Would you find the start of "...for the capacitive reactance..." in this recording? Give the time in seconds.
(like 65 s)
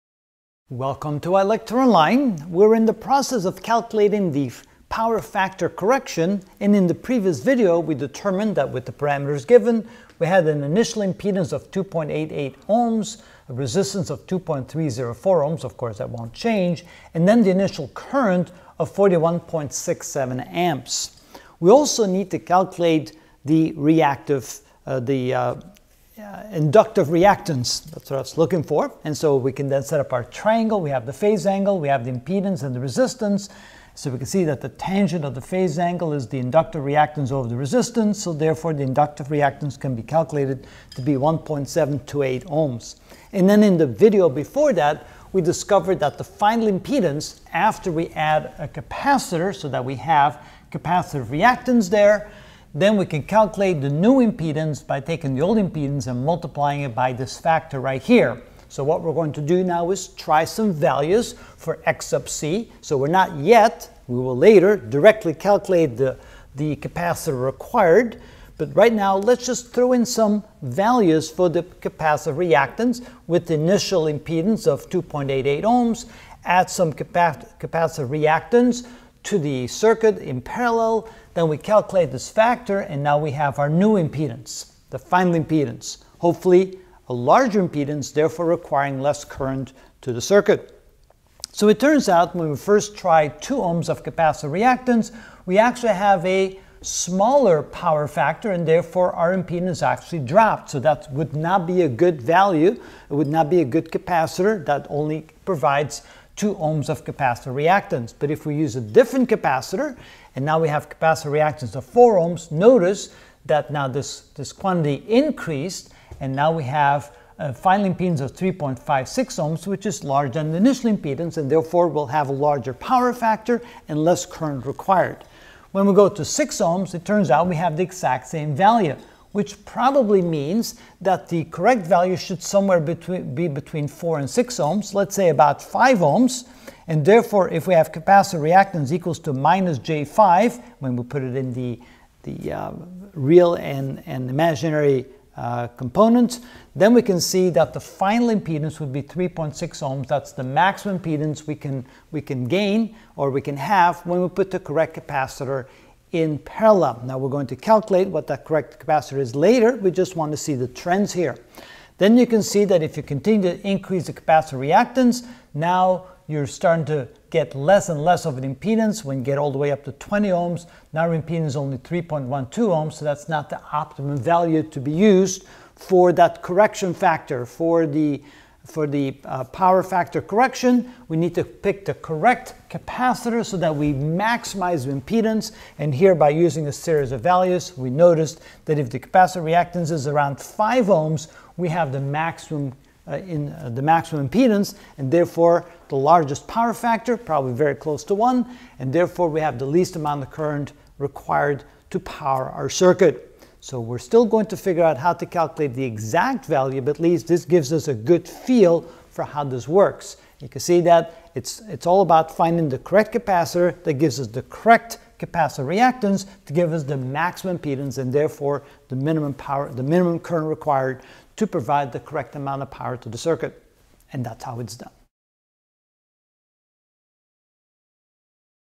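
71 s.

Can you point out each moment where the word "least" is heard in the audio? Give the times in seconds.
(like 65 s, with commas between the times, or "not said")
199 s, 206 s.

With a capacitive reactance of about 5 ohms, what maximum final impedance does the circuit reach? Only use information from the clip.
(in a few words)
3.6 ohms.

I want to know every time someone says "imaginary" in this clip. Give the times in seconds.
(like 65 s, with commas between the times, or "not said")
144 s.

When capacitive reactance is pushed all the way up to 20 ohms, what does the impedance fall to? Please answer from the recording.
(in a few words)
3.12 ohms.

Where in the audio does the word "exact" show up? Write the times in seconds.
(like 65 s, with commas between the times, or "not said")
127 s, 205 s.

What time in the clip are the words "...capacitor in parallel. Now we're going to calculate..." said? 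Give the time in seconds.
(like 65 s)
154 s.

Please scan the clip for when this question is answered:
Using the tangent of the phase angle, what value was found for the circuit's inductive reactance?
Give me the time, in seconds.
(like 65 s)
41 s.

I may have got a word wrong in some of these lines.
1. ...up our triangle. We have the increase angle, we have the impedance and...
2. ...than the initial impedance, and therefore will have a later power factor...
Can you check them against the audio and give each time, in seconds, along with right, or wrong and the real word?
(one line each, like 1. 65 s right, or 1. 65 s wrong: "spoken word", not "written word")
1. 29 s wrong: "phase", not "increase"
2. 120 s wrong: "larger", not "later".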